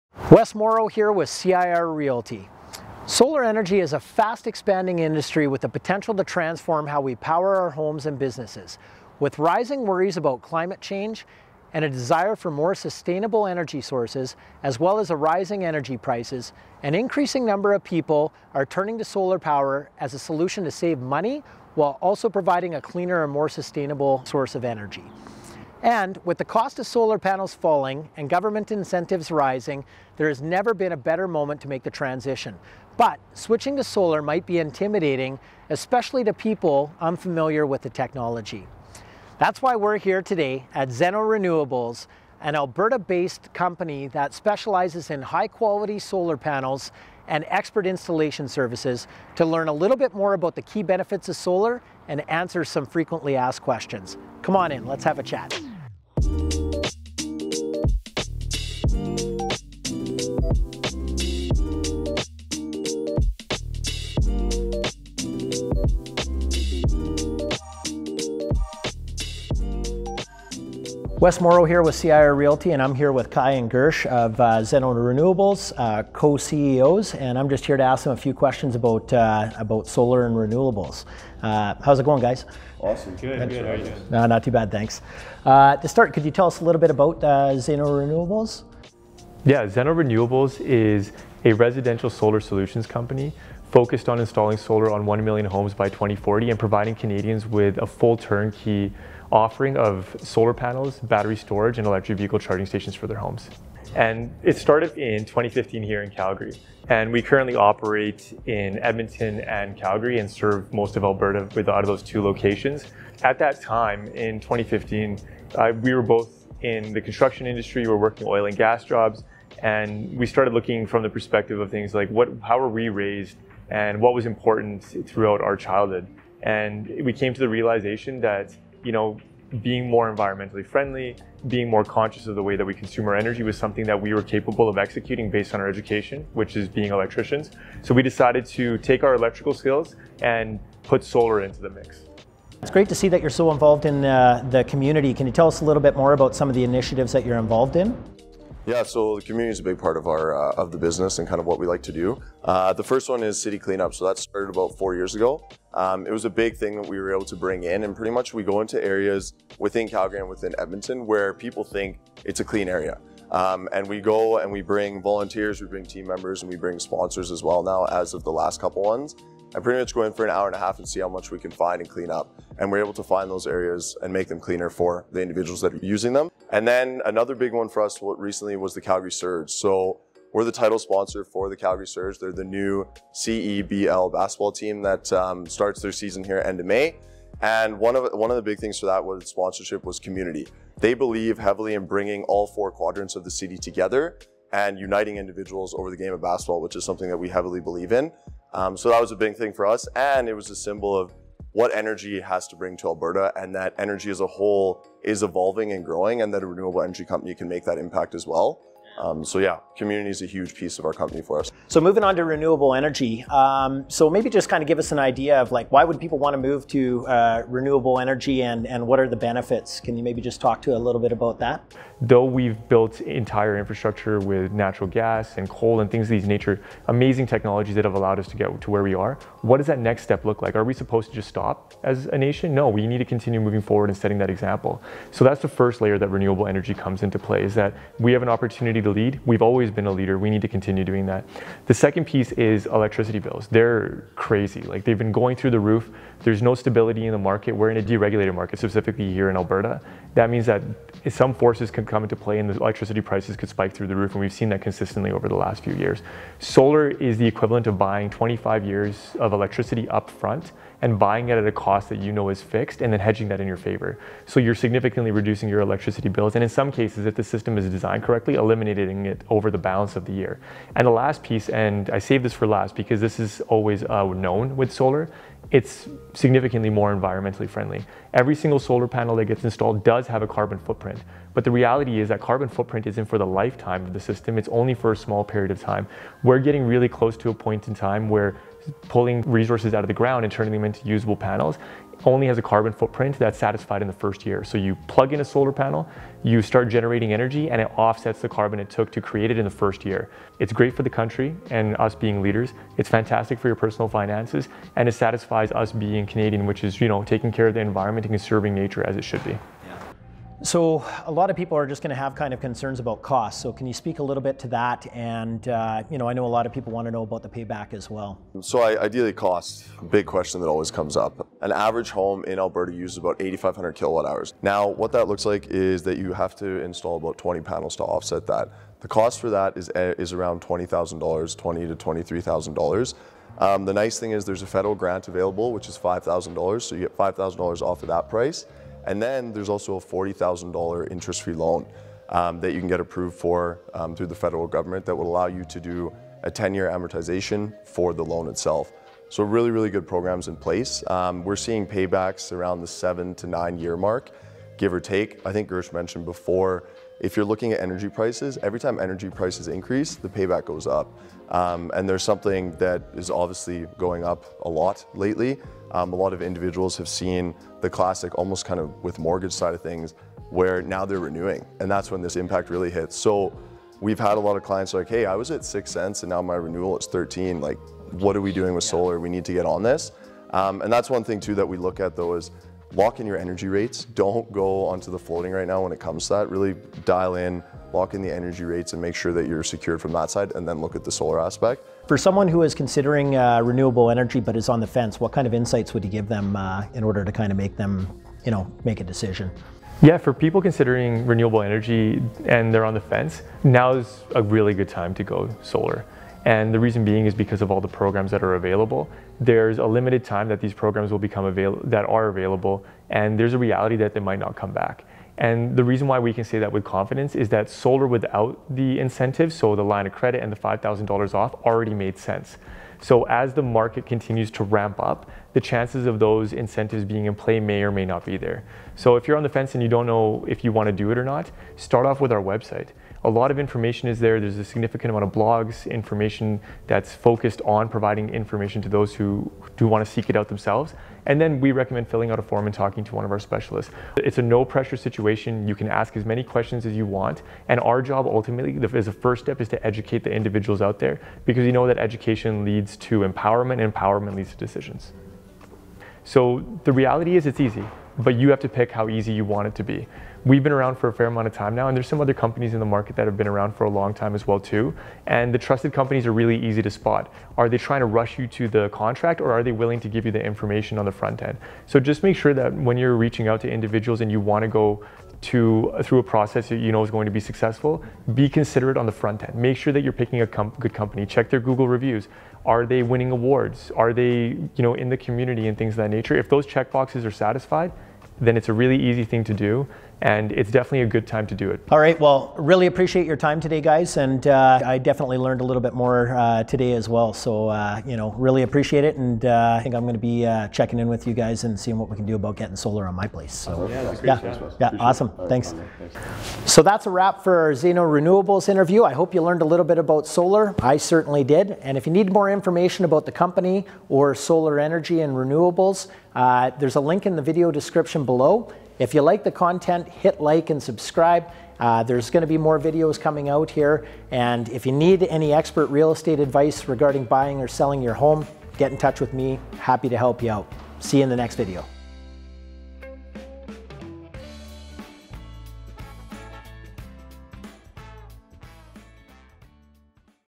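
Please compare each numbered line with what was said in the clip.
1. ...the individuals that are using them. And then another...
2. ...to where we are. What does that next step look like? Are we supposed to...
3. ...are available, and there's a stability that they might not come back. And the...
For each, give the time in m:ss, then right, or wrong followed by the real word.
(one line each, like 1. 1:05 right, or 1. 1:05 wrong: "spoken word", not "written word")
1. 2:55 right
2. 3:48 right
3. 6:51 wrong: "reality", not "stability".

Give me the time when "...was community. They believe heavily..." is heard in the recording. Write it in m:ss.
3:09.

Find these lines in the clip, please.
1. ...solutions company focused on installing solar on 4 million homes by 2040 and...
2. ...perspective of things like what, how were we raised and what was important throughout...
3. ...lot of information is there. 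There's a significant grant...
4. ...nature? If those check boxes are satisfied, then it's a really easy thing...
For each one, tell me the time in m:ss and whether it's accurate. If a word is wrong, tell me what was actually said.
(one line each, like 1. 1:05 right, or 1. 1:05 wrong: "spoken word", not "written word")
1. 1:32 wrong: "1", not "4"
2. 2:01 right
3. 7:13 wrong: "amount", not "grant"
4. 8:05 right.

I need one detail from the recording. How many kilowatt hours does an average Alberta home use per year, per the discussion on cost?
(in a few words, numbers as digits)
8,500.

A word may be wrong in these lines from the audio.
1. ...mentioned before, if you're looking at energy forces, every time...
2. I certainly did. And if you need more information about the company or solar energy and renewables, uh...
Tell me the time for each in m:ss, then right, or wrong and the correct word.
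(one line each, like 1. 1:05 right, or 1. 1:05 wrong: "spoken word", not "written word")
1. 5:55 wrong: "prices", not "forces"
2. 8:30 right.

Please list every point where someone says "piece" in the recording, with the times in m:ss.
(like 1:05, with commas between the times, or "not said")
3:30, 4:02, 4:31.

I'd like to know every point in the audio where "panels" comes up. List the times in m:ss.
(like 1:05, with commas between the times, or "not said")
0:27, 0:46, 1:40, 4:38, 4:51, 4:55, 5:27.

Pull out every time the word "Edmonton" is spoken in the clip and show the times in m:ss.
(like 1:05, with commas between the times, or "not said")
1:48, 2:40.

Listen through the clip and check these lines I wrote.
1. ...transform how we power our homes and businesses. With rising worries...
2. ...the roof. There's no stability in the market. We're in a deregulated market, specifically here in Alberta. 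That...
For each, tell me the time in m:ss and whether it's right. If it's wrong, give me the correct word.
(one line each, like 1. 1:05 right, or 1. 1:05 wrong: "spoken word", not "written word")
1. 0:06 right
2. 4:05 right.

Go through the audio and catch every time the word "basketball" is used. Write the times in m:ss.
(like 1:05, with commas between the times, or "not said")
3:04, 3:16.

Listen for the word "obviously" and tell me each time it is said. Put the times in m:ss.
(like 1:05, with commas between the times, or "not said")
6:03.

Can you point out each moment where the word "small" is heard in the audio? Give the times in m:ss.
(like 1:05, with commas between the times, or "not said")
4:44.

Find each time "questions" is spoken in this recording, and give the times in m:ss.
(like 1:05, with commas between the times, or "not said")
0:53, 1:18, 5:20, 7:26.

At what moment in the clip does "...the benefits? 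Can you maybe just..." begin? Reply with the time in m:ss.
3:39.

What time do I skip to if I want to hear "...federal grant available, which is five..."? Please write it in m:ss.
5:34.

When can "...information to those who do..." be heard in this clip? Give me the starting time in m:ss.
7:18.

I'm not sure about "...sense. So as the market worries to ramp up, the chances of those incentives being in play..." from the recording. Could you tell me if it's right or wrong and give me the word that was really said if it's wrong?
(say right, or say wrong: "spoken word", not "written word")
wrong: "continues", not "worries".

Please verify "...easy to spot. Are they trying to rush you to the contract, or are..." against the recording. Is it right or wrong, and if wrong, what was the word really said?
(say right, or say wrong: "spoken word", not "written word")
right.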